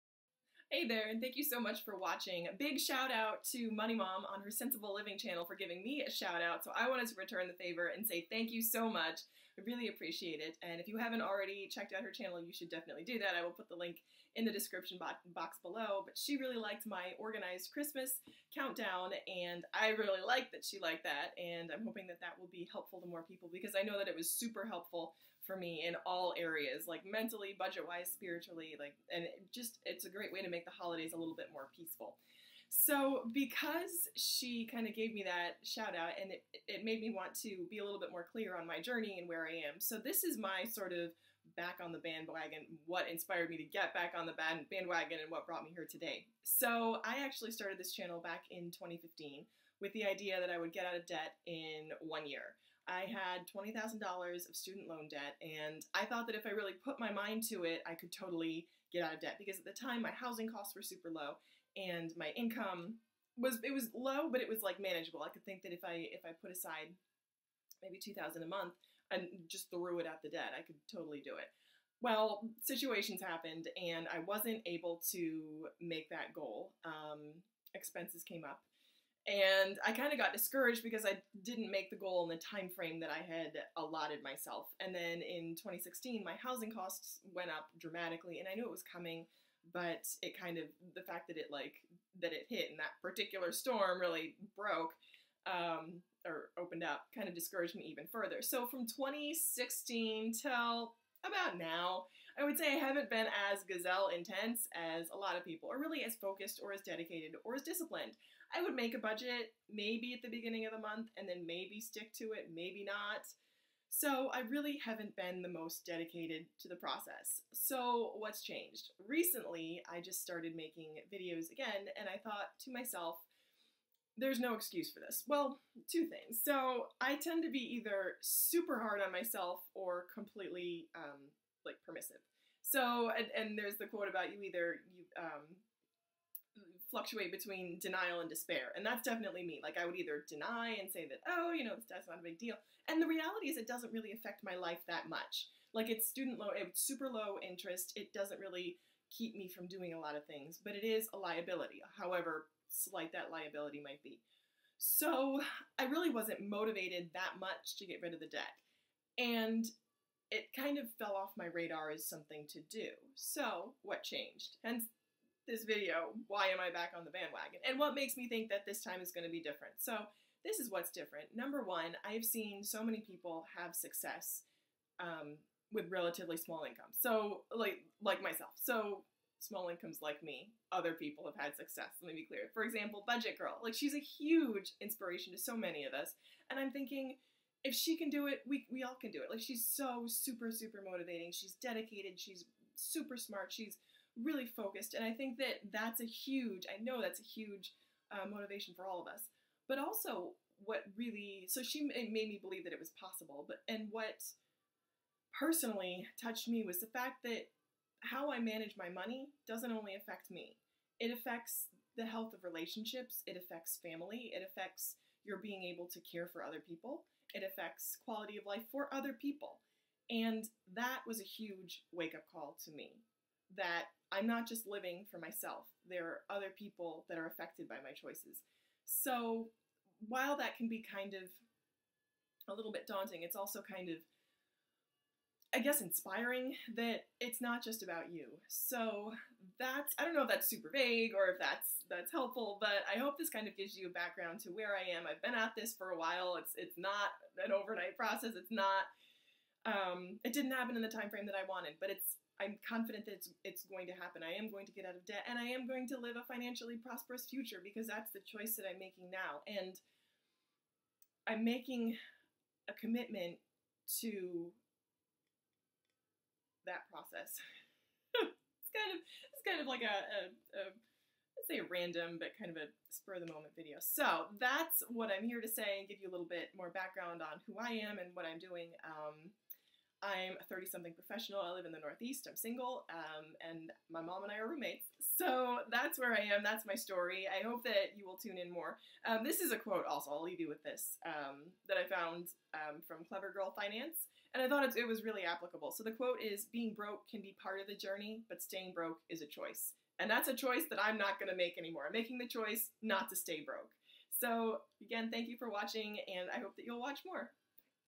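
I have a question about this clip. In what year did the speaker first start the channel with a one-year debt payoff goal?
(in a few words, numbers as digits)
2015.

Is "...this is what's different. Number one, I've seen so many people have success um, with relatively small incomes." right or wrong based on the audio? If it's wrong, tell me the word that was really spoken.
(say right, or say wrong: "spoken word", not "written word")
right.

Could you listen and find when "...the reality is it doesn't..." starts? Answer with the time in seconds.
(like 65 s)
143 s.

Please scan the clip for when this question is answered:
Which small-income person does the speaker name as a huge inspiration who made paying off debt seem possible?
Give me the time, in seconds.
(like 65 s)
183 s.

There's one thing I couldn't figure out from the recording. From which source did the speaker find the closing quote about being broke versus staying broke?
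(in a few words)
Clever Girl Finance.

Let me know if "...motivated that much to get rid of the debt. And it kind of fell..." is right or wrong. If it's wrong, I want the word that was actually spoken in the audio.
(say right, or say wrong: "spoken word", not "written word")
right.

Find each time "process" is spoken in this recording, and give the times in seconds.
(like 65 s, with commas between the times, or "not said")
116 s, 247 s, 266 s.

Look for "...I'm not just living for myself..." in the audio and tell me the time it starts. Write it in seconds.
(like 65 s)
224 s.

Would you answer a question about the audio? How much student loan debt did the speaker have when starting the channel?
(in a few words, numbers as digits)
$20,000.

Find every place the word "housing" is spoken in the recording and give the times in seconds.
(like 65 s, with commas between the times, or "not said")
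60 s, 86 s.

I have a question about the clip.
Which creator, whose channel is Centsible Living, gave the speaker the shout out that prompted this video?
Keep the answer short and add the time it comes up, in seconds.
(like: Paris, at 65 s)
Money Mom, at 3 s.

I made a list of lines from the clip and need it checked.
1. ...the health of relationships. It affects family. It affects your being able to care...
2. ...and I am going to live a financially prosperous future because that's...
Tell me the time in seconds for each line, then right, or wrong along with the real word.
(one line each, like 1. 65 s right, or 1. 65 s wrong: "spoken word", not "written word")
1. 211 s right
2. 255 s right.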